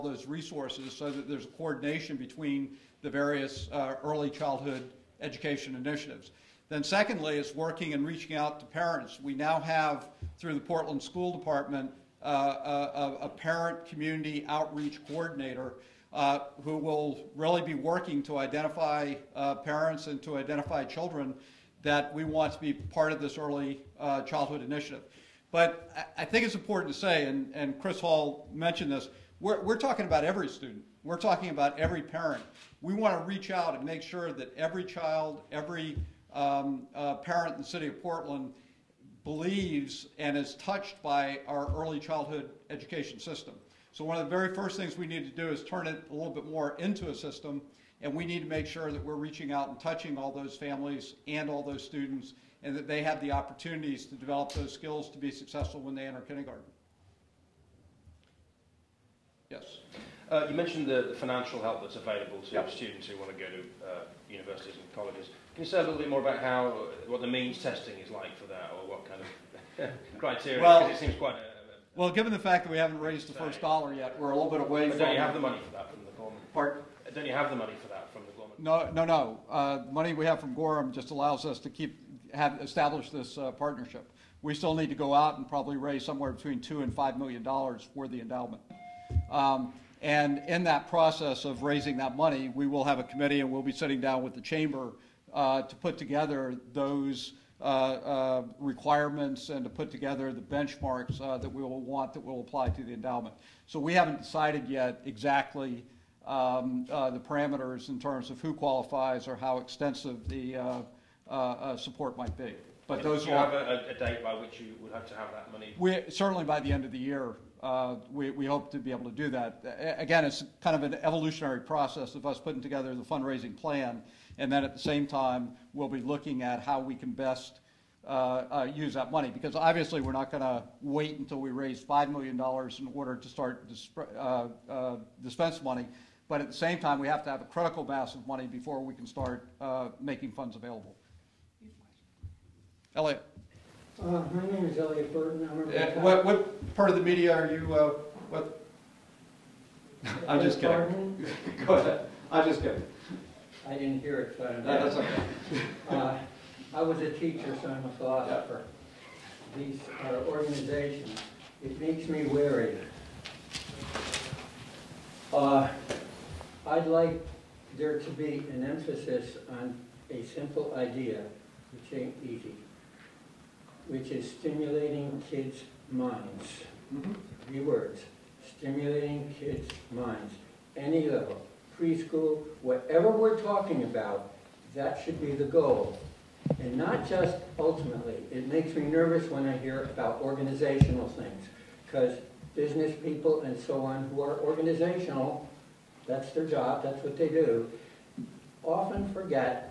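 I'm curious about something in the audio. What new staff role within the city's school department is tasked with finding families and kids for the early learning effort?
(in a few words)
Parent community outreach coordinator.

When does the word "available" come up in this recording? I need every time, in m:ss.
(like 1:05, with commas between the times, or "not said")
1:01, 2:20.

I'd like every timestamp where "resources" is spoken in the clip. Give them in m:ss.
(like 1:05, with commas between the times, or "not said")
0:00.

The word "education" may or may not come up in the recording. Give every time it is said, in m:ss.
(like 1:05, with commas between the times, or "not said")
0:05, 0:42.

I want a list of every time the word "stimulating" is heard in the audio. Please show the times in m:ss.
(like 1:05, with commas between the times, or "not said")
2:54, 2:58.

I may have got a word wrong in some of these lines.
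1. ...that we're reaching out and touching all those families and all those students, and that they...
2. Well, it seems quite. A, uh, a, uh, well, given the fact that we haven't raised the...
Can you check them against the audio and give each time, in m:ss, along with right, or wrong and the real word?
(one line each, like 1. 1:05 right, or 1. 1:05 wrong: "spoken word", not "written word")
1. 0:48 right
2. 1:10 right.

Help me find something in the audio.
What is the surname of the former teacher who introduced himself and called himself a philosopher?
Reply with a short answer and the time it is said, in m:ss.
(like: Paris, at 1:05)
Burton, at 2:25.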